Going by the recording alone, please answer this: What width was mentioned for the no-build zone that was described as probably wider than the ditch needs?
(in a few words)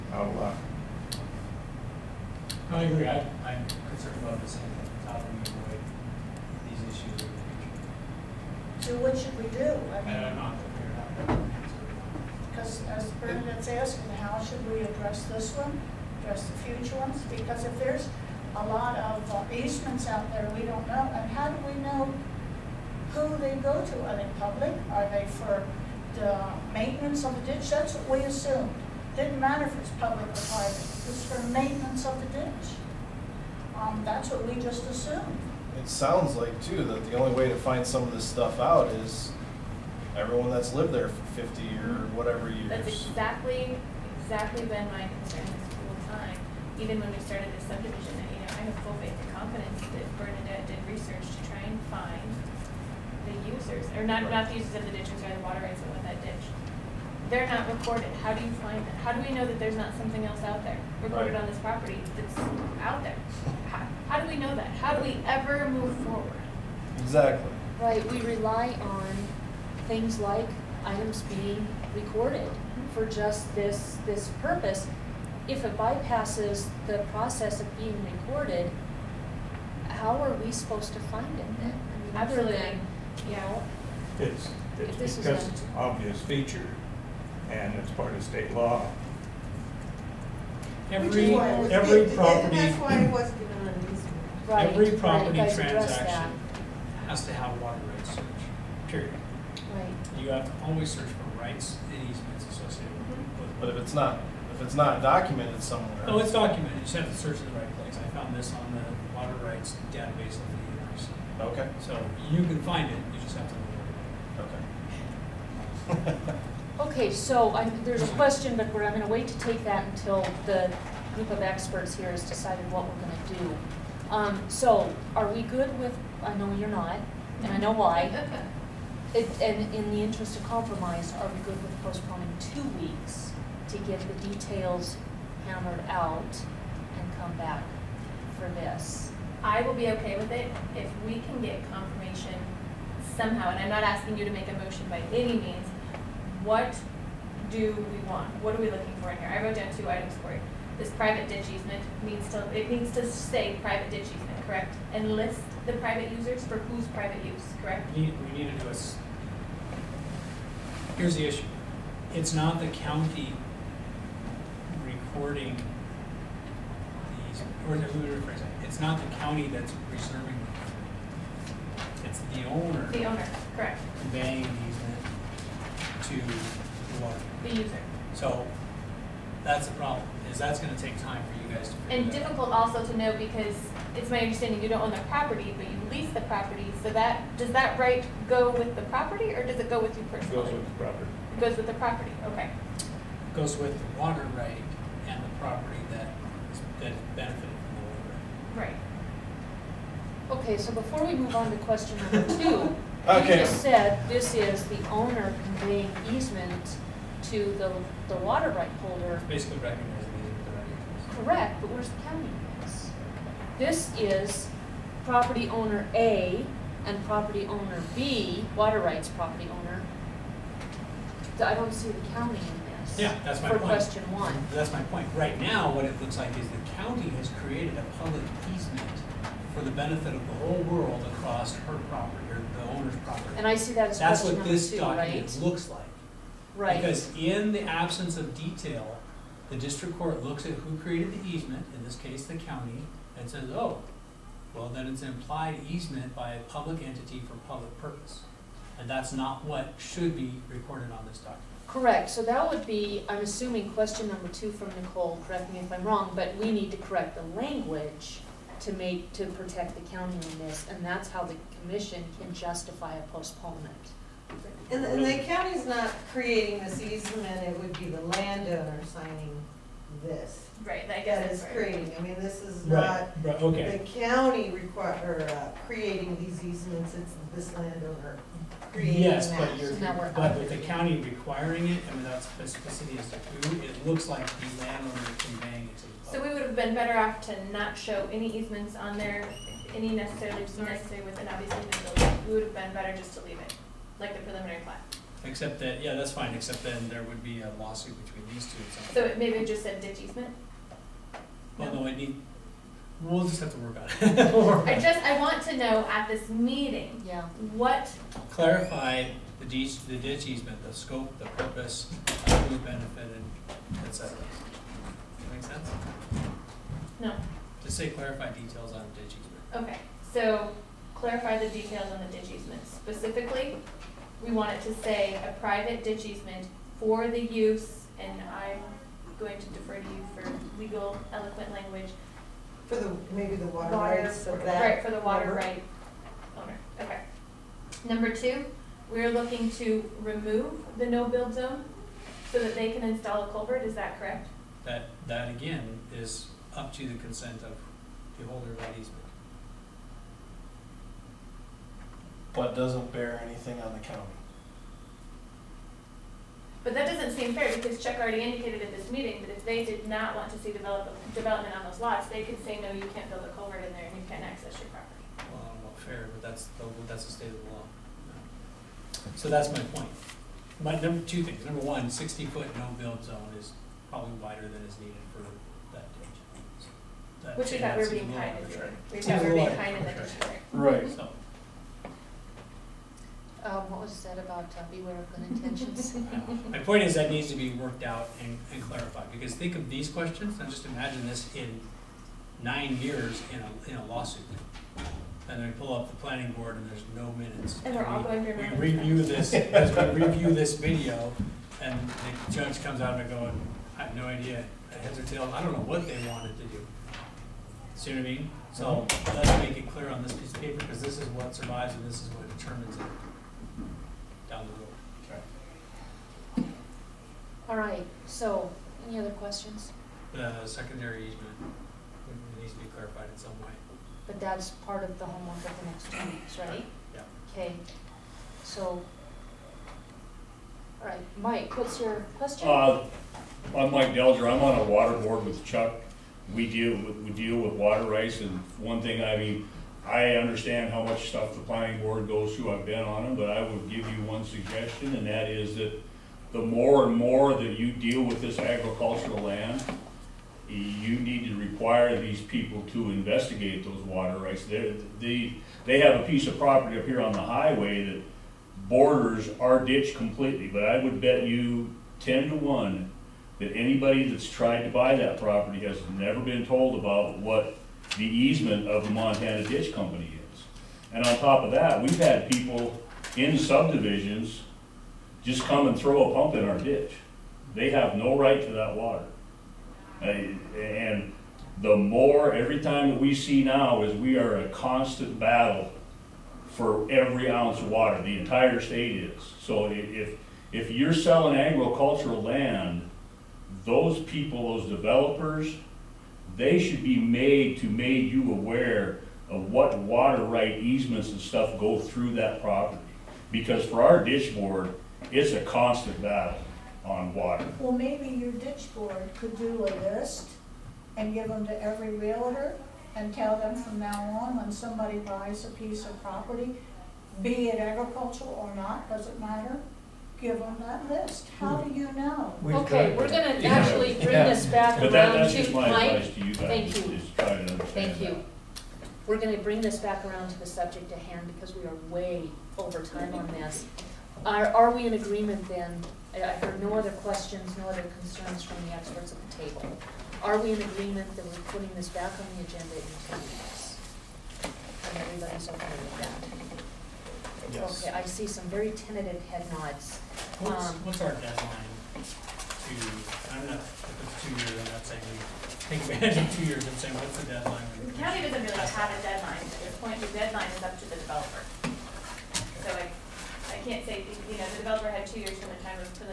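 60 foot.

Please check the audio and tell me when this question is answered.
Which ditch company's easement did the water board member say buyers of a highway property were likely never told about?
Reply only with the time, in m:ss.
7:48.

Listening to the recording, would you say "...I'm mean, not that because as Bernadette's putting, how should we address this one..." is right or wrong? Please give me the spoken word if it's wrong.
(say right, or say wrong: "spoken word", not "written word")
wrong: "asking", not "putting".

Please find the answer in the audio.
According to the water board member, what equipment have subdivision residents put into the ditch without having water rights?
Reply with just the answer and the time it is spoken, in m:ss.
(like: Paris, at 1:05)
A pump, at 7:56.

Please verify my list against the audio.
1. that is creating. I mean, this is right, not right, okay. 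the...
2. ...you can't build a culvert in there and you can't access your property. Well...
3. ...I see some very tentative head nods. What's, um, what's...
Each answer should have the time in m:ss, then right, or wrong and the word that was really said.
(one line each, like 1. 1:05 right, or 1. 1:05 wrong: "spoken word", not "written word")
1. 4:30 right
2. 6:02 right
3. 9:07 right.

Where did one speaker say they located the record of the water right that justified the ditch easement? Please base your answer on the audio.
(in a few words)
Water rights database.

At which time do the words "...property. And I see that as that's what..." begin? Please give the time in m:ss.
3:52.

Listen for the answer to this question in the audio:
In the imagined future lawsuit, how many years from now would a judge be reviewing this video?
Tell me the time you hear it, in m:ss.
6:32.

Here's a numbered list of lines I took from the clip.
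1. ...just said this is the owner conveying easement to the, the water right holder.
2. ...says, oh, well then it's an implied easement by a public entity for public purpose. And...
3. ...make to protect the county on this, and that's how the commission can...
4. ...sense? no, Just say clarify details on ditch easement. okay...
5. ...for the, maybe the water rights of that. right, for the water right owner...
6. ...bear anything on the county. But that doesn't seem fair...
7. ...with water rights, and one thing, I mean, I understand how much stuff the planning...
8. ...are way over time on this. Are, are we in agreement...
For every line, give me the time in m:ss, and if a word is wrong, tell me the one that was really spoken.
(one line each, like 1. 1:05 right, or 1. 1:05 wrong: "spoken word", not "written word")
1. 3:23 right
2. 4:03 right
3. 4:18 right
4. 5:15 right
5. 5:32 right
6. 5:52 right
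7. 7:17 right
8. 8:51 right.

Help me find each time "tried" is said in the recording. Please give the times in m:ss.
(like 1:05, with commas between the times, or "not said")
7:44.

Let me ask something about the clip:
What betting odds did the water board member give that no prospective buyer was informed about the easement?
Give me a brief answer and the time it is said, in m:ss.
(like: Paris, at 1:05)
10 to 1, at 7:42.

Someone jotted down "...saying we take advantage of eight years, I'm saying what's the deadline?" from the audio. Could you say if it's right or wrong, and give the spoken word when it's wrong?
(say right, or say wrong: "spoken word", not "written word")
wrong: "two", not "eight".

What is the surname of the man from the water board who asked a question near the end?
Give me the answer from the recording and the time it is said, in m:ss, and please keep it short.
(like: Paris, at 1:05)
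Delger, at 7:13.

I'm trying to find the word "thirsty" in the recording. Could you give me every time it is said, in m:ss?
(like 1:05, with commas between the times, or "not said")
not said.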